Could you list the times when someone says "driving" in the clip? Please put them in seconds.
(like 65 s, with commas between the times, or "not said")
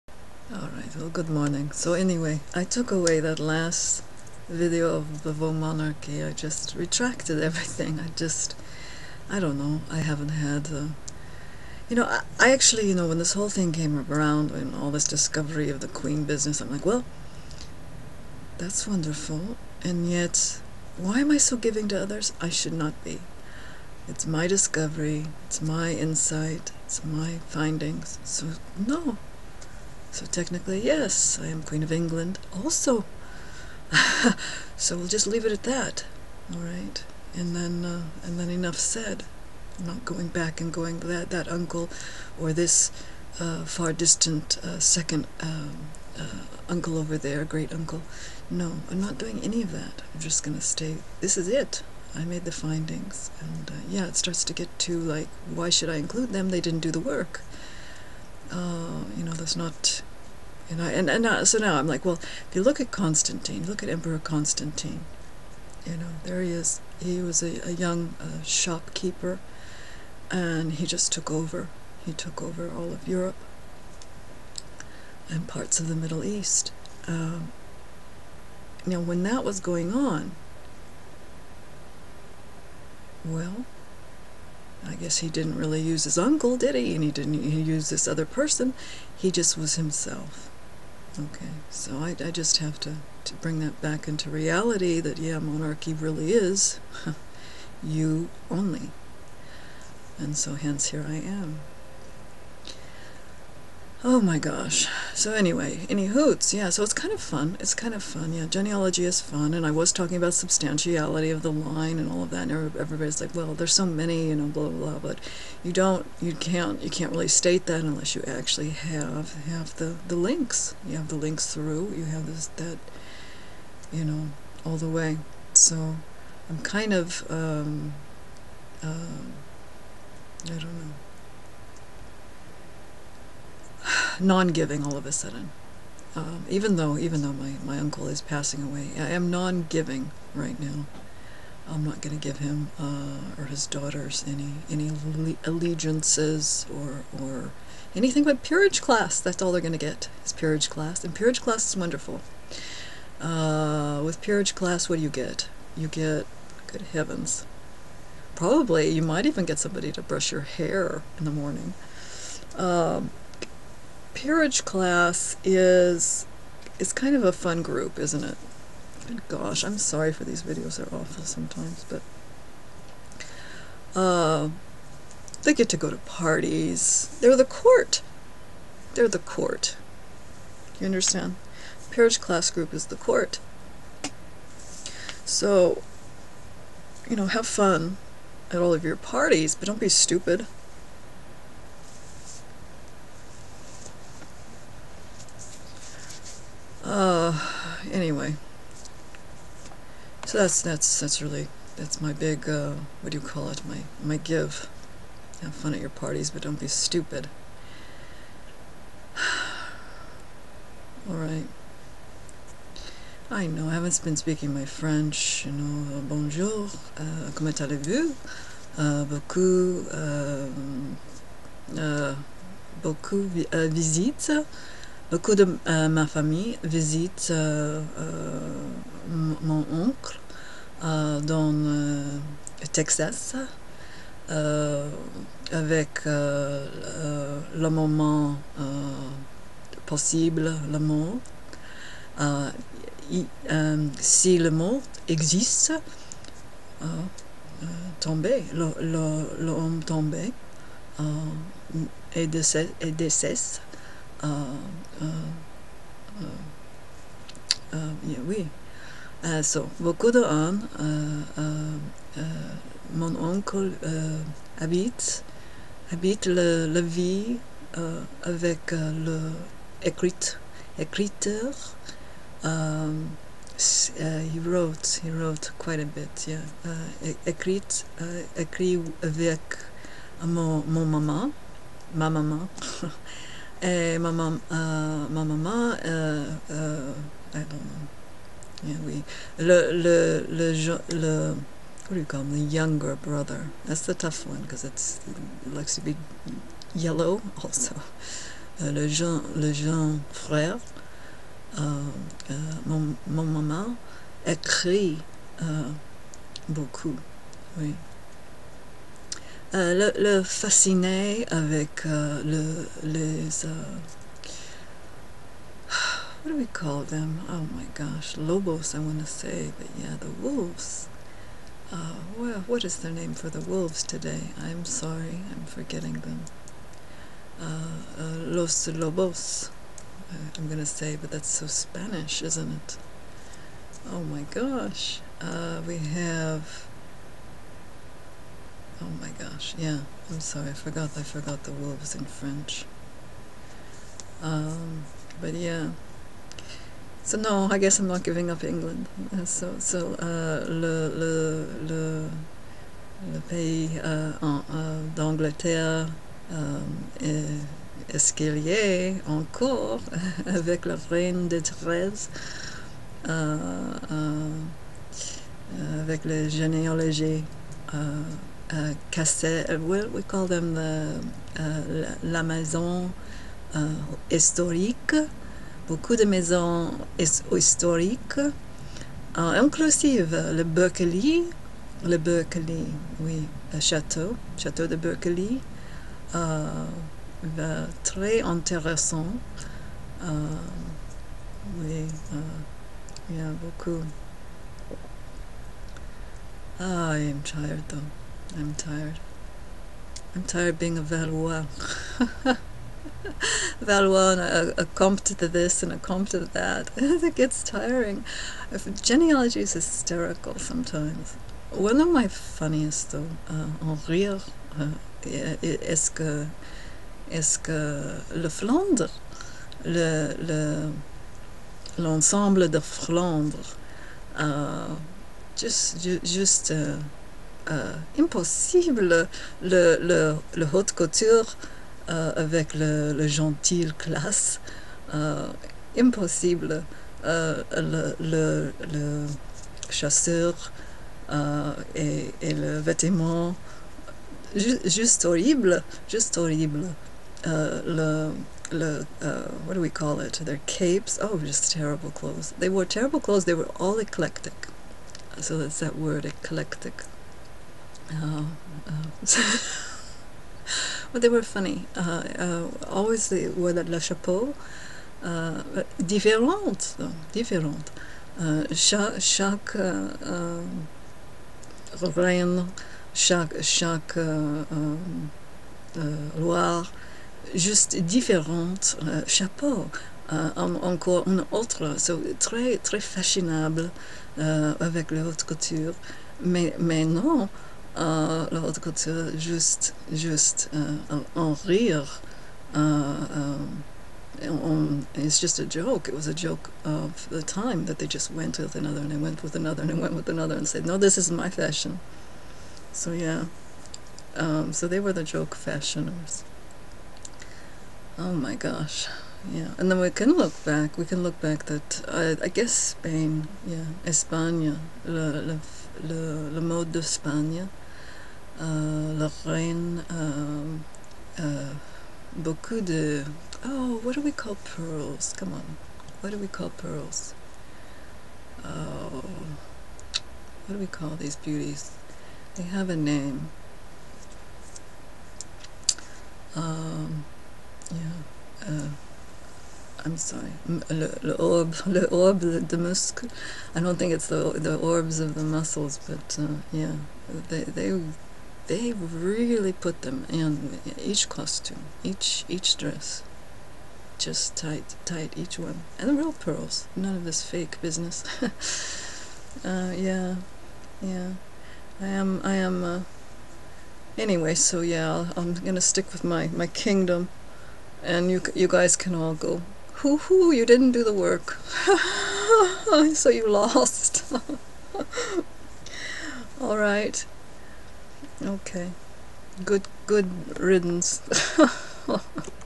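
not said.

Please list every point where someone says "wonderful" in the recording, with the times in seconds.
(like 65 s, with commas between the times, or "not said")
18 s, 151 s.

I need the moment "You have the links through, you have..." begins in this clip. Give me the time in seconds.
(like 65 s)
120 s.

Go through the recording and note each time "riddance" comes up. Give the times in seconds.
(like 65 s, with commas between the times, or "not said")
580 s.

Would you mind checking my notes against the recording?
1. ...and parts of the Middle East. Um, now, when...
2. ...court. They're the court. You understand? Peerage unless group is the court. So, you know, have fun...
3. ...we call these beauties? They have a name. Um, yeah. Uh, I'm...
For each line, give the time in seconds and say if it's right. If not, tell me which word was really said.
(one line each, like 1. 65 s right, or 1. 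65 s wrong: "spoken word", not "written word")
1. 75 s right
2. 177 s wrong: "class", not "unless"
3. 530 s right.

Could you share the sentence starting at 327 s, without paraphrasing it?
Uh, uh, los lobos, uh, I'm going to say, but that's so Spanish, isn't it?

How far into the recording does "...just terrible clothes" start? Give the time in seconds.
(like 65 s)
451 s.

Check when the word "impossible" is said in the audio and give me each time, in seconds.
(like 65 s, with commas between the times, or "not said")
427 s, 435 s.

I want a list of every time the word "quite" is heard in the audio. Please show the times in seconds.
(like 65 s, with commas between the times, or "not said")
275 s.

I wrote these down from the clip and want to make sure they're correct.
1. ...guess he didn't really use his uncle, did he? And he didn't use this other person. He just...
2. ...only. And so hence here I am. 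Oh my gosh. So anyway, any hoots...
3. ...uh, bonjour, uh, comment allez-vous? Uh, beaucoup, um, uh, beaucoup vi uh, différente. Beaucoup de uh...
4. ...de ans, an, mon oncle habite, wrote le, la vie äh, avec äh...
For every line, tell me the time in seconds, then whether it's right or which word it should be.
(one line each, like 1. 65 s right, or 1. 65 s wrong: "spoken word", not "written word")
1. 84 s right
2. 98 s right
3. 215 s wrong: "visite", not "différente"
4. 259 s wrong: "habite", not "wrote".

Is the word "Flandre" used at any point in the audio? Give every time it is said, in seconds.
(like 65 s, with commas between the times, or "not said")
418 s, 422 s.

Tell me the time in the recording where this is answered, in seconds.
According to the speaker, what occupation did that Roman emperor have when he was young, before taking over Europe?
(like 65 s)
68 s.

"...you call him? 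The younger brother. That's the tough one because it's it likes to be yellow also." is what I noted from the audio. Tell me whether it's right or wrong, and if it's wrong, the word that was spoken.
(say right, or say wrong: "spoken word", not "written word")
right.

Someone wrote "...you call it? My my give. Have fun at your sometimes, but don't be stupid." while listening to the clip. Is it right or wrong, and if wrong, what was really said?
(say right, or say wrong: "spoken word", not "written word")
wrong: "parties", not "sometimes".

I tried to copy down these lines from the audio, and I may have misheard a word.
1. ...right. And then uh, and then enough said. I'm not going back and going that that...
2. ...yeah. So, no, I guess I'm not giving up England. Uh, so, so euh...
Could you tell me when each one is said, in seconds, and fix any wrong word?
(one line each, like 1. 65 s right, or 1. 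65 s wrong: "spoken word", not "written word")
1. 36 s right
2. 345 s right.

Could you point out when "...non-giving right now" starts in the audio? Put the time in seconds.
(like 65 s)
139 s.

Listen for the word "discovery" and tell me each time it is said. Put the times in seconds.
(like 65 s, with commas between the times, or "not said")
15 s, 24 s.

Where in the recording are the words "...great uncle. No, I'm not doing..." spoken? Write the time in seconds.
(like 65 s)
47 s.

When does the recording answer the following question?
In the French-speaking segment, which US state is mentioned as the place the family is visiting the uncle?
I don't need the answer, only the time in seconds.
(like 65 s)
232 s.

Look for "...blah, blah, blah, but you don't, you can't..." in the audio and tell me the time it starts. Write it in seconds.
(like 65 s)
114 s.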